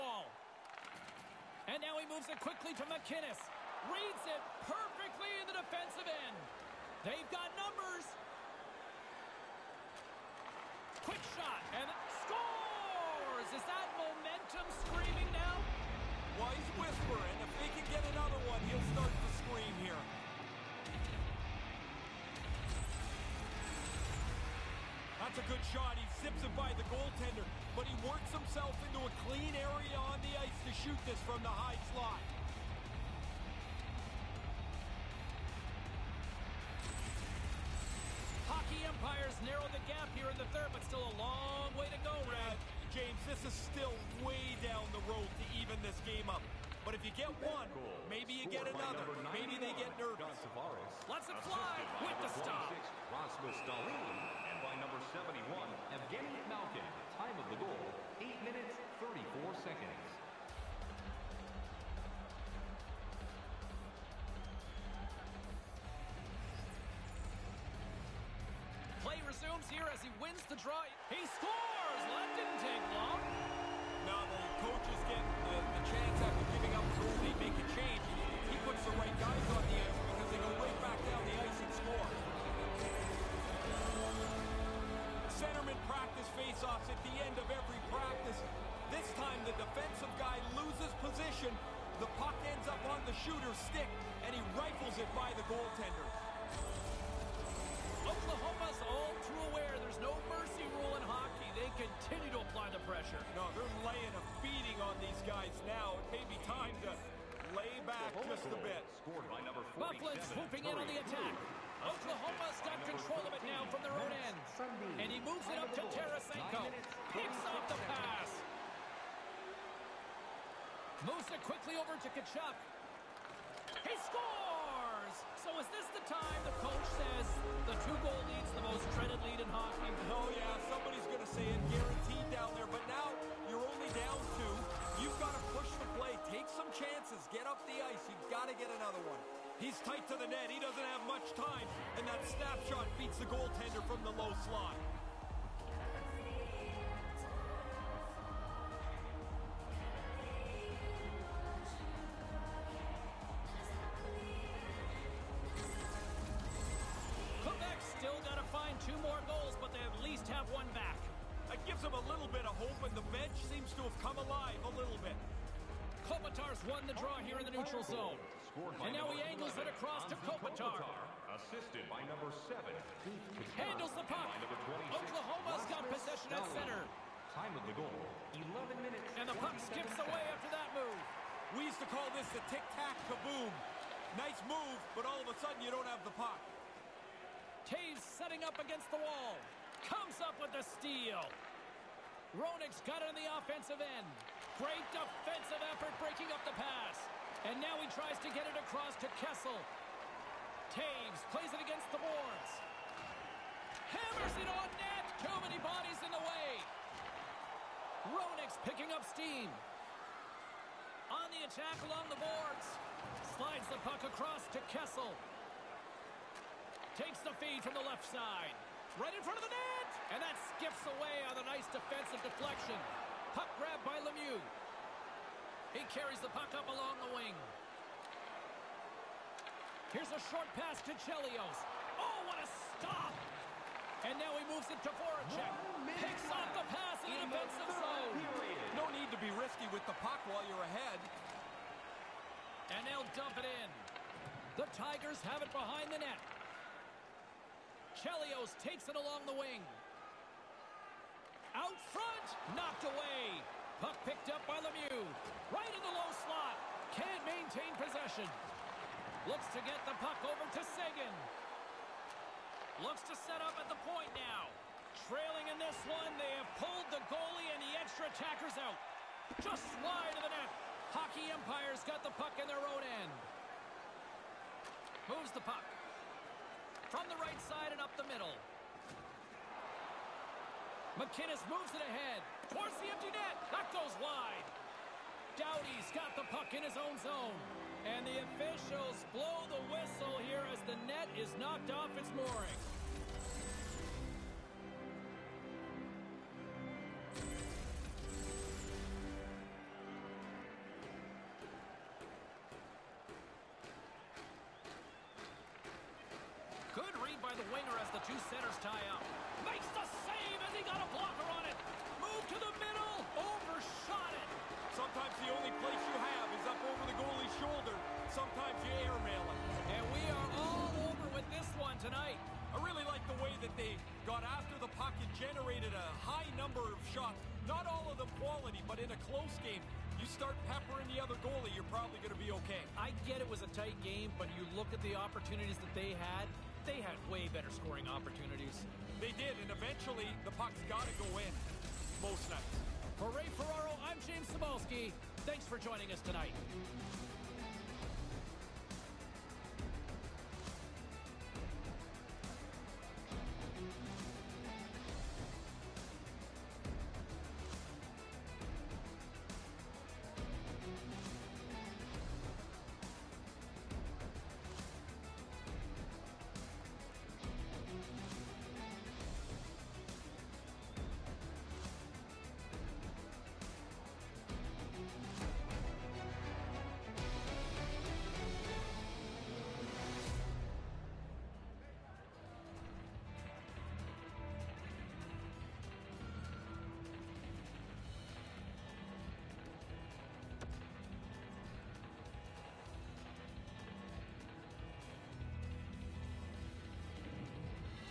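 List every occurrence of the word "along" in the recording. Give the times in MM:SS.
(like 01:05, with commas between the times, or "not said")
03:31, 03:46, 04:08.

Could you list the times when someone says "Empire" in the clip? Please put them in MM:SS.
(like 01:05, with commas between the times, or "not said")
00:38, 04:31.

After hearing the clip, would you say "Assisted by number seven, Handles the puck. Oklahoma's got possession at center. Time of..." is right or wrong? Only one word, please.
right.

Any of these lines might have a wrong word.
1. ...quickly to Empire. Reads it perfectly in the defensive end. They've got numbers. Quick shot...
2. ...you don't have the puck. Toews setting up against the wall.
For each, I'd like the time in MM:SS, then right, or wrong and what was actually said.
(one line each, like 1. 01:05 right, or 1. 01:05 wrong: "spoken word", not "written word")
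1. 00:02 wrong: "McKinnis", not "Empire"
2. 03:05 right.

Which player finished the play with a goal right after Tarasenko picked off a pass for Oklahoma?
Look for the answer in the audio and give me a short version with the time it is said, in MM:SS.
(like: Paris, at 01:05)
Tkachuk, at 02:02.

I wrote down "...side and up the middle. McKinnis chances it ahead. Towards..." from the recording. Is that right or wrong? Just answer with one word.
wrong.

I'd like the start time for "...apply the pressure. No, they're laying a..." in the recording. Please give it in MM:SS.
01:42.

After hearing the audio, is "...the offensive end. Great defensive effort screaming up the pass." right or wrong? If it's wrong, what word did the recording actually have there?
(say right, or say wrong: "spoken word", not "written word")
wrong: "breaking", not "screaming".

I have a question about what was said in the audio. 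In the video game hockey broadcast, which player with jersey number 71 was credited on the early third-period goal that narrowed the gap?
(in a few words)
Evgeny Malkin.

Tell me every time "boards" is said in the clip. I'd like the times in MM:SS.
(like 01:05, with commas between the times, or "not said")
03:21, 03:32.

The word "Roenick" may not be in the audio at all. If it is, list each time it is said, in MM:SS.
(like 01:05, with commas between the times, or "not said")
03:12, 03:28.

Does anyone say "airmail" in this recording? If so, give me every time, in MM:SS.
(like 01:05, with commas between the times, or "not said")
05:18.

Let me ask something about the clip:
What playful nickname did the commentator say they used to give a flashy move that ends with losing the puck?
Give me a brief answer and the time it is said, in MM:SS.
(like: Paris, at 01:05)
tic-tac-kaboom, at 03:02.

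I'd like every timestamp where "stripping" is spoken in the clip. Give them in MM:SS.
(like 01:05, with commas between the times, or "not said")
not said.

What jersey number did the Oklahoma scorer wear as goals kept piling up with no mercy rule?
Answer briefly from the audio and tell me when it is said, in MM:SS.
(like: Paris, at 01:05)
47, at 01:49.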